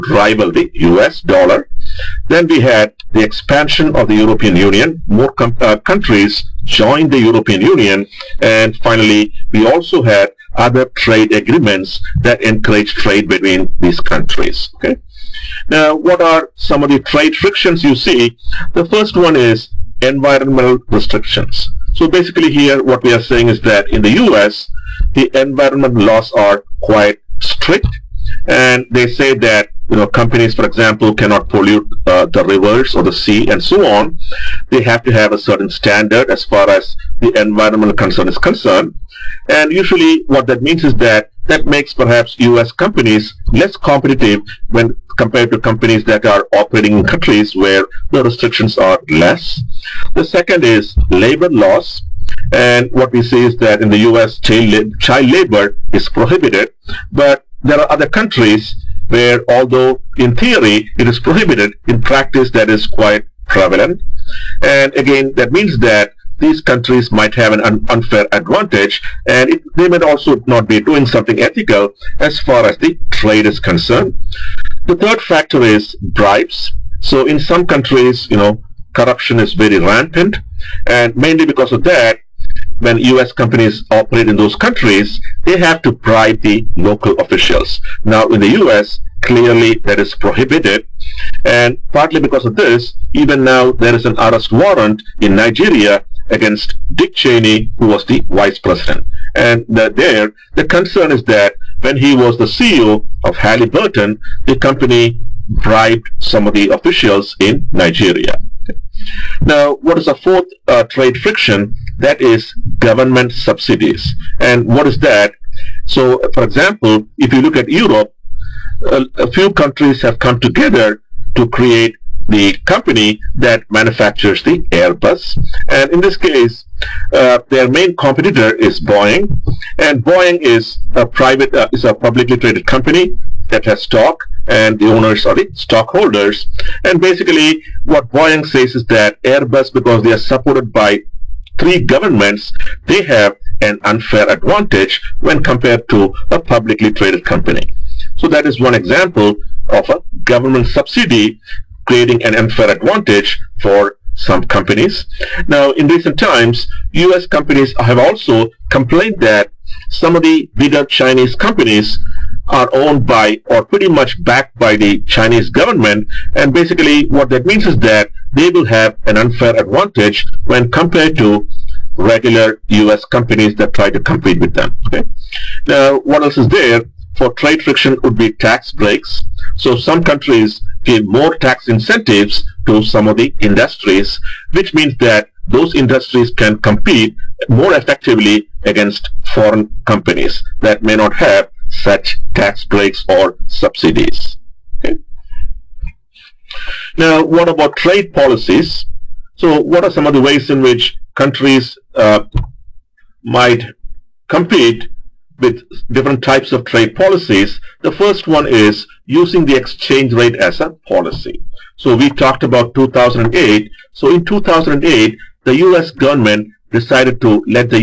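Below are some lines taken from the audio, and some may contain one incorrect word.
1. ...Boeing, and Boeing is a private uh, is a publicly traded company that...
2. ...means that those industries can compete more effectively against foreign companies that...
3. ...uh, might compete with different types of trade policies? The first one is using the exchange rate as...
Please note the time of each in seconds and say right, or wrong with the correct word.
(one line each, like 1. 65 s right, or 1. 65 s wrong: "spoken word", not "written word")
1. 128 s right
2. 184 s right
3. 201 s right.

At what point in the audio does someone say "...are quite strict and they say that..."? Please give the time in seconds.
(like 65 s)
26 s.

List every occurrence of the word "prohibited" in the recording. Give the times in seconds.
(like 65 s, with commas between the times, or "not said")
56 s, 61 s, 90 s.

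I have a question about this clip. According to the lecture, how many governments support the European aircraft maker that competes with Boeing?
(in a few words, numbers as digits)
3.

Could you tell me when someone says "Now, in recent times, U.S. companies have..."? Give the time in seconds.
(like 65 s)
155 s.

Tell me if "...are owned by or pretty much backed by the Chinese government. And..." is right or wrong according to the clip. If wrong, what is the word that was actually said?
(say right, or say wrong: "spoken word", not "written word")
right.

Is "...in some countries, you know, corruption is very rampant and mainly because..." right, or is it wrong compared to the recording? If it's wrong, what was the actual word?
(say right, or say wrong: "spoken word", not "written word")
right.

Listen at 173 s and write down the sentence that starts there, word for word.
companies that try to compete with them.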